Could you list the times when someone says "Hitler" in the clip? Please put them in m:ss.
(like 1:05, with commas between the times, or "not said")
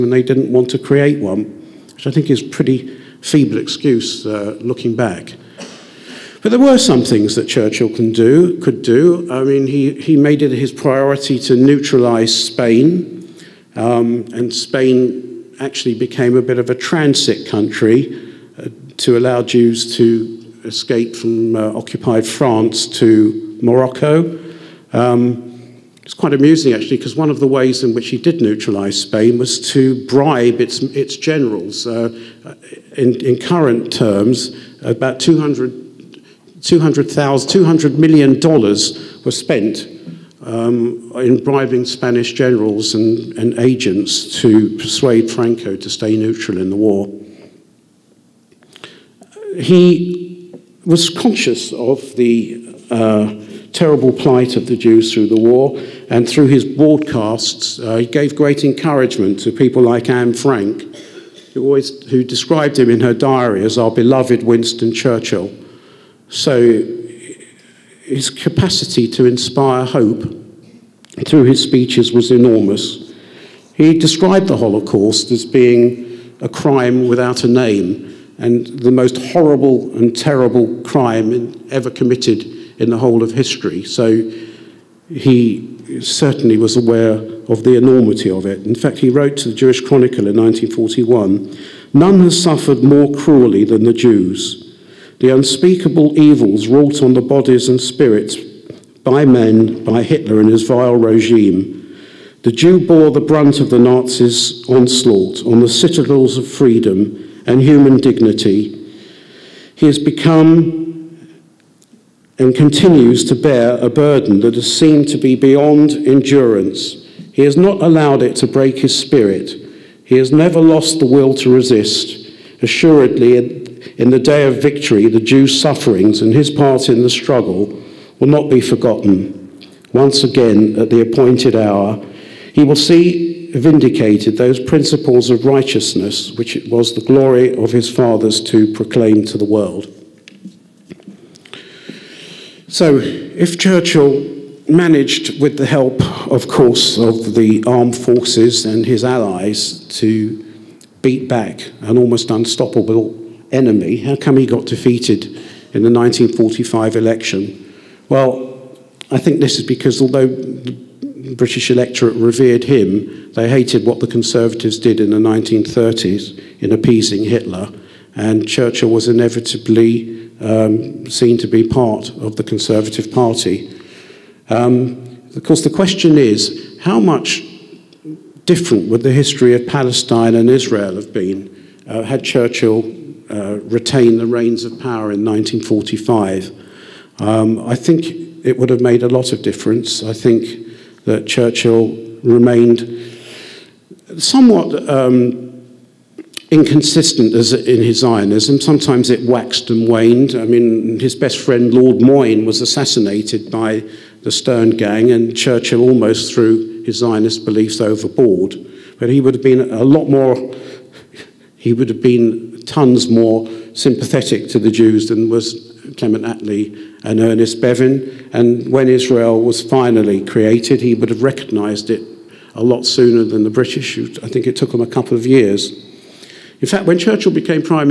1:40, 2:47.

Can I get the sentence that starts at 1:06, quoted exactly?
So his capacity to inspire hope through his speeches was enormous.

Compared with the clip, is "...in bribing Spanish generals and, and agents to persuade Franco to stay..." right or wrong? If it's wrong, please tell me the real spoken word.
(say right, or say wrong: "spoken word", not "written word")
right.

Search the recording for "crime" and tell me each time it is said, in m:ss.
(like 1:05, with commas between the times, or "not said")
1:16, 1:20.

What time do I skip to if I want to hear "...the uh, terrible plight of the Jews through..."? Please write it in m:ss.
0:52.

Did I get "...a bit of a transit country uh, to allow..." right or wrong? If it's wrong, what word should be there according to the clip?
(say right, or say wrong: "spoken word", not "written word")
right.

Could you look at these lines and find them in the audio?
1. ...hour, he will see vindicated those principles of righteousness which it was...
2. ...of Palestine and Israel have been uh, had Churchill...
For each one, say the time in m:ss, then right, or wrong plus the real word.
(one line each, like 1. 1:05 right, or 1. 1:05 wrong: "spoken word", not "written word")
1. 2:11 right
2. 2:59 right.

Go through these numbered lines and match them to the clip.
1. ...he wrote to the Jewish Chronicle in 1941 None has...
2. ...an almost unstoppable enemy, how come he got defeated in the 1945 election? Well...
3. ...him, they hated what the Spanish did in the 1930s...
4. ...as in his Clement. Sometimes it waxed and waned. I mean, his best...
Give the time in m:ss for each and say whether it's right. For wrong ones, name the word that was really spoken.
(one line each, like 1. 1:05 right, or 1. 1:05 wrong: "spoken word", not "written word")
1. 1:28 right
2. 2:31 right
3. 2:42 wrong: "Conservatives", not "Spanish"
4. 3:17 wrong: "Zionism", not "Clement".